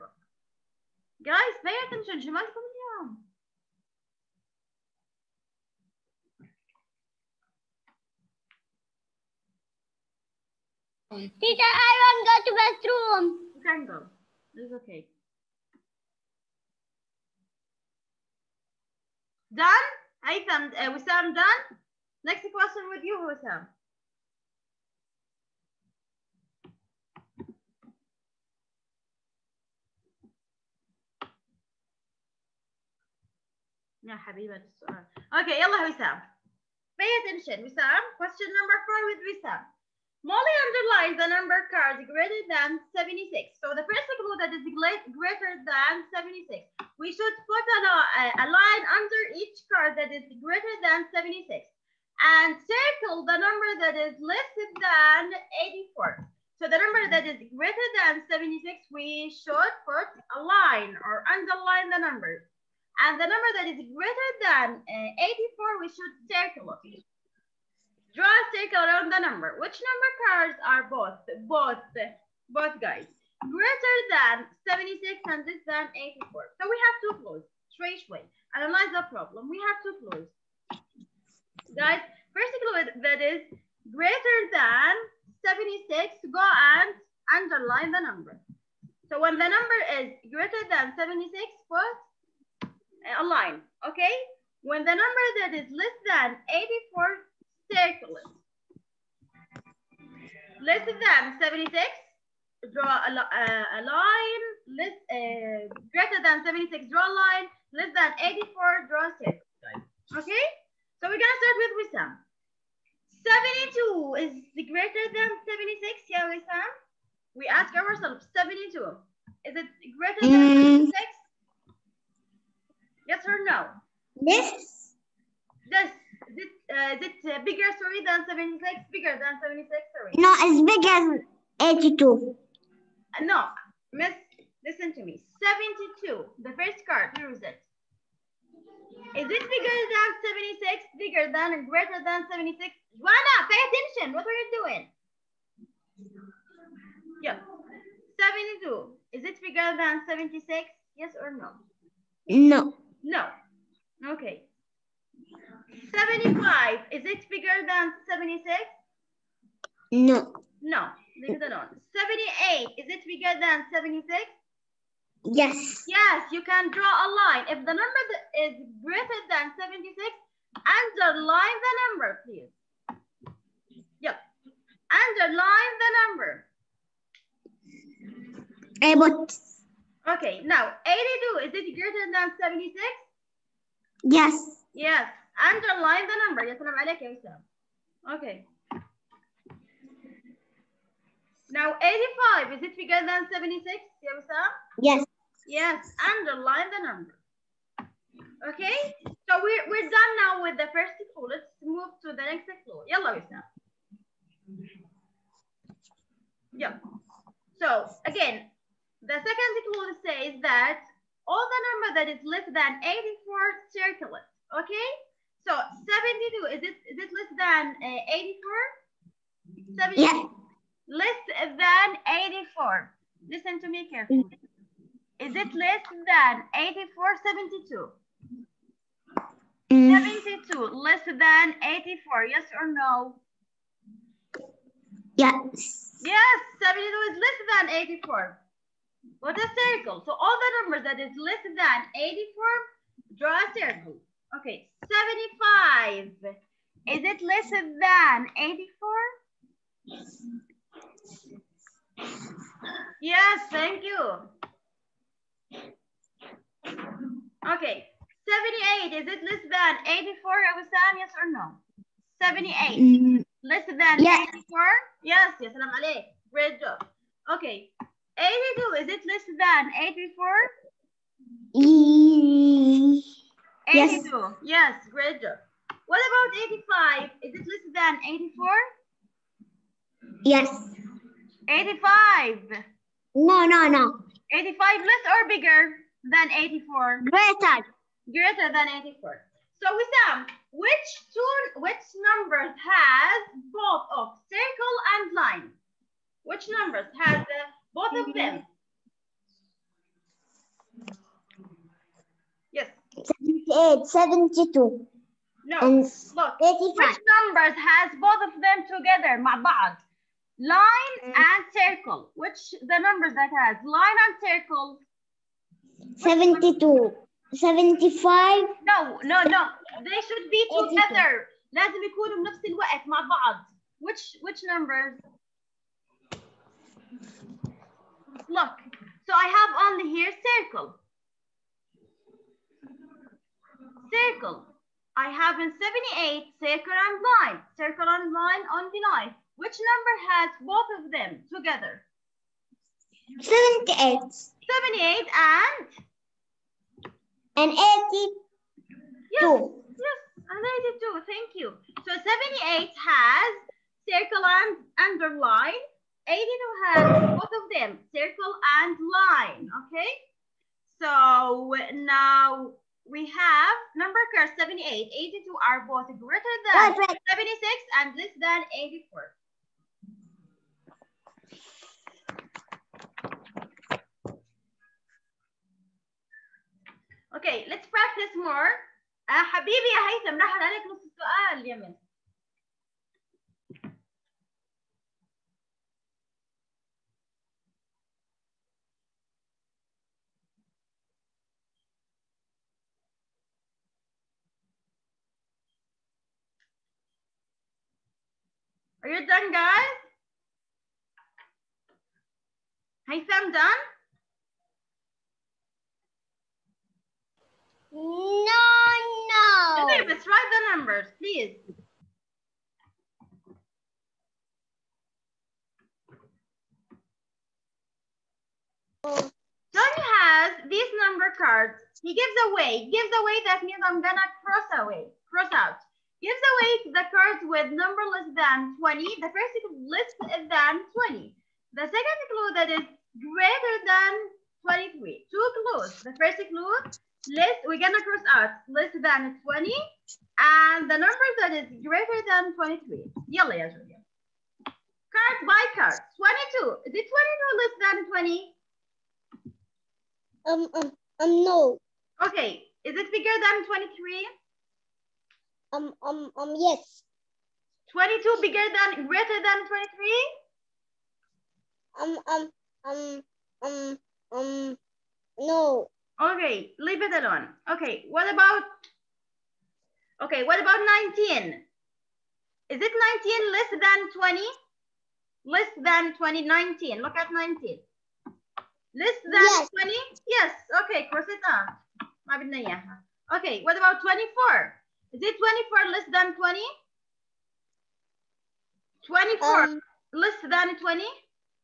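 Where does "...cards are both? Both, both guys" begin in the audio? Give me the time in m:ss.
1:10.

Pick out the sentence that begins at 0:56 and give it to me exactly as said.
So the number that is greater than 76, we should put a line or underline the number.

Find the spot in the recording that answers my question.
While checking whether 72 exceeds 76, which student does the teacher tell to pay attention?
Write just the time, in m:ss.
2:22.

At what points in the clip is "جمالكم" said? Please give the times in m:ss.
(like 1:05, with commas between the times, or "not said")
0:02.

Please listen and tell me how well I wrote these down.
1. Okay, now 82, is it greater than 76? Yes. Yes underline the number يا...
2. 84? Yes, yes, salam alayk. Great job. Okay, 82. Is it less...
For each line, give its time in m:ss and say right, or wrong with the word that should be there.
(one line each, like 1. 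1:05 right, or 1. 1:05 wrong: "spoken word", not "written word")
1. 3:00 right
2. 4:24 right.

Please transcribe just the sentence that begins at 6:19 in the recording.
حبيبي يا هيثم راح عليك نص السؤال يا من.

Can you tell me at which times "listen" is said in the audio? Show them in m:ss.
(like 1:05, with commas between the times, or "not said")
2:14, 3:43.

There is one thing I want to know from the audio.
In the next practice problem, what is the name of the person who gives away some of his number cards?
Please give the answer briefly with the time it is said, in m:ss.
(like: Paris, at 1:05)
Tony, at 6:58.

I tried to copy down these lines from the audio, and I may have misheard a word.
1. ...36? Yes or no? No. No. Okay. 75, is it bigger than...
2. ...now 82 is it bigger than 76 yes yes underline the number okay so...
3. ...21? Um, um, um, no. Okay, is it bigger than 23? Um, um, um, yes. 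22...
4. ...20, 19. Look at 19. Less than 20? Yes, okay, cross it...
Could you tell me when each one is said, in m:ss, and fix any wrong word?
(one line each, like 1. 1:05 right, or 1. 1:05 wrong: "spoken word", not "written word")
1. 2:30 wrong: "76", not "36"
2. 3:11 wrong: "85", not "82"
3. 7:27 wrong: "20", not "21"
4. 7:55 right.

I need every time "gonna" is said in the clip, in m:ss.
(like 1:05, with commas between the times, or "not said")
1:51, 7:03, 7:17.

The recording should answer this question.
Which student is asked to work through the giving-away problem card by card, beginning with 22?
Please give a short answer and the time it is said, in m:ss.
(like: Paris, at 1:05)
Julia, at 7:23.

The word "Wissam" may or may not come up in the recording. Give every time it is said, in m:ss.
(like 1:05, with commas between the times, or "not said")
0:23, 1:51, 1:56.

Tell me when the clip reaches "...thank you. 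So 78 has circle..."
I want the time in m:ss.
5:51.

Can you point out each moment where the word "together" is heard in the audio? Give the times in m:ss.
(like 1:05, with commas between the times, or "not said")
5:08, 5:20, 5:41.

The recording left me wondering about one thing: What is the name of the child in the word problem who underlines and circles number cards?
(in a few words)
Molly.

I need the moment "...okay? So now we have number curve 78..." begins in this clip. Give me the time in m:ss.
5:59.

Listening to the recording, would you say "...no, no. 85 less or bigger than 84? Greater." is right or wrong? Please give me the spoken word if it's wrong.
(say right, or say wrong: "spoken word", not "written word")
right.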